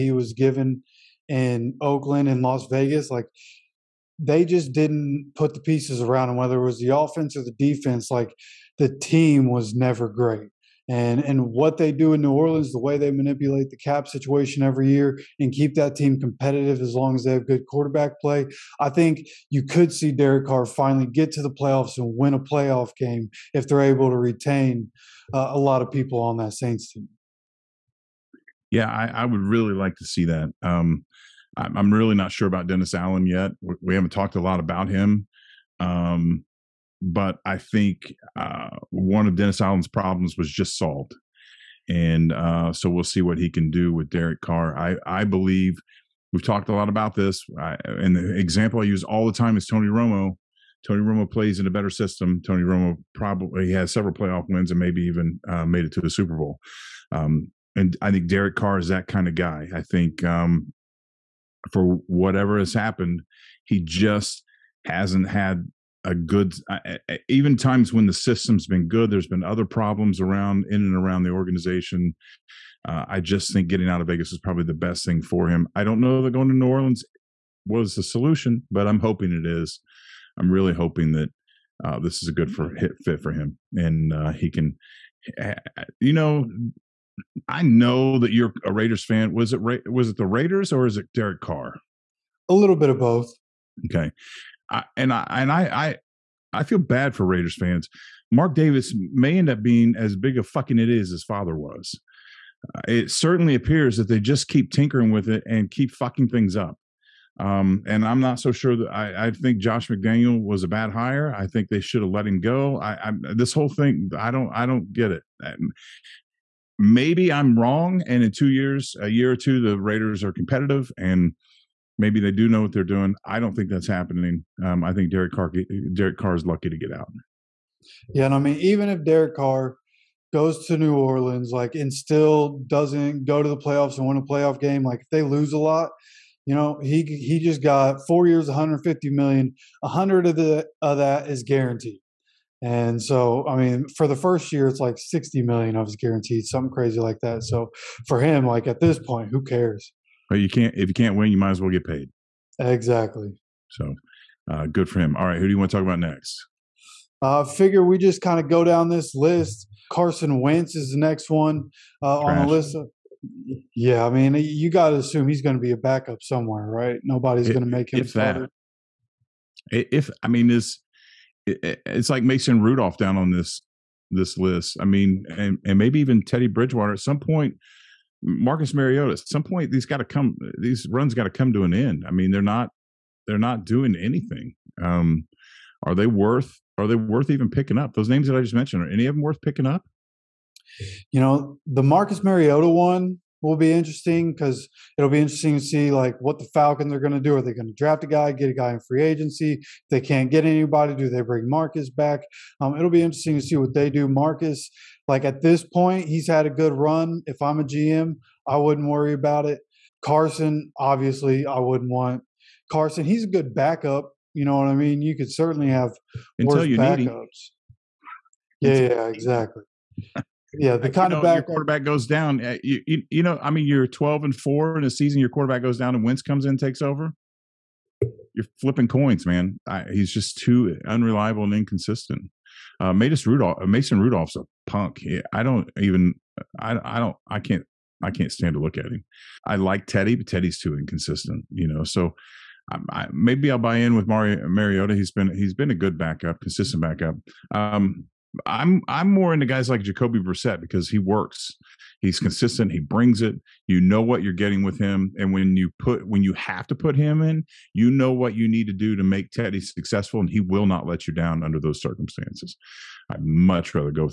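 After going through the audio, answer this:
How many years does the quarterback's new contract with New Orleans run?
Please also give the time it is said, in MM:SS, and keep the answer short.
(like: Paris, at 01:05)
4, at 02:18.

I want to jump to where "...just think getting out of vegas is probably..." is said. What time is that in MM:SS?
01:13.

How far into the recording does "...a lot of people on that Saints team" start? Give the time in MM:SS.
00:25.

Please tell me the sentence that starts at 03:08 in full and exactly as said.
Are any of them worth picking up?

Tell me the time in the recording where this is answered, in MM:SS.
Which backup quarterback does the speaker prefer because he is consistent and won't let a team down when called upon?
04:09.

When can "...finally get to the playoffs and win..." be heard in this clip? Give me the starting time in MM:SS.
00:20.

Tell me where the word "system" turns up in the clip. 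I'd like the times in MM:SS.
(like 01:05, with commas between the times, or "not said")
00:51, 01:08.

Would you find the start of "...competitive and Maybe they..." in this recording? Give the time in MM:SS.
02:00.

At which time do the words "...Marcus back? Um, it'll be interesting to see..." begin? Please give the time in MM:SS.
03:21.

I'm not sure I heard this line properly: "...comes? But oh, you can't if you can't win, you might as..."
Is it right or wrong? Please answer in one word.
wrong.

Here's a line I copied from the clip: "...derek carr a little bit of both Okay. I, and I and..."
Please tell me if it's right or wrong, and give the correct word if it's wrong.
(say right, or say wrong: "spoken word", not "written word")
right.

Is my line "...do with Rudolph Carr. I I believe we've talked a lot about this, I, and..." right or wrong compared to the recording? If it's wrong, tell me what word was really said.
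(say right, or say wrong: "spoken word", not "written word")
wrong: "Derek", not "Rudolph".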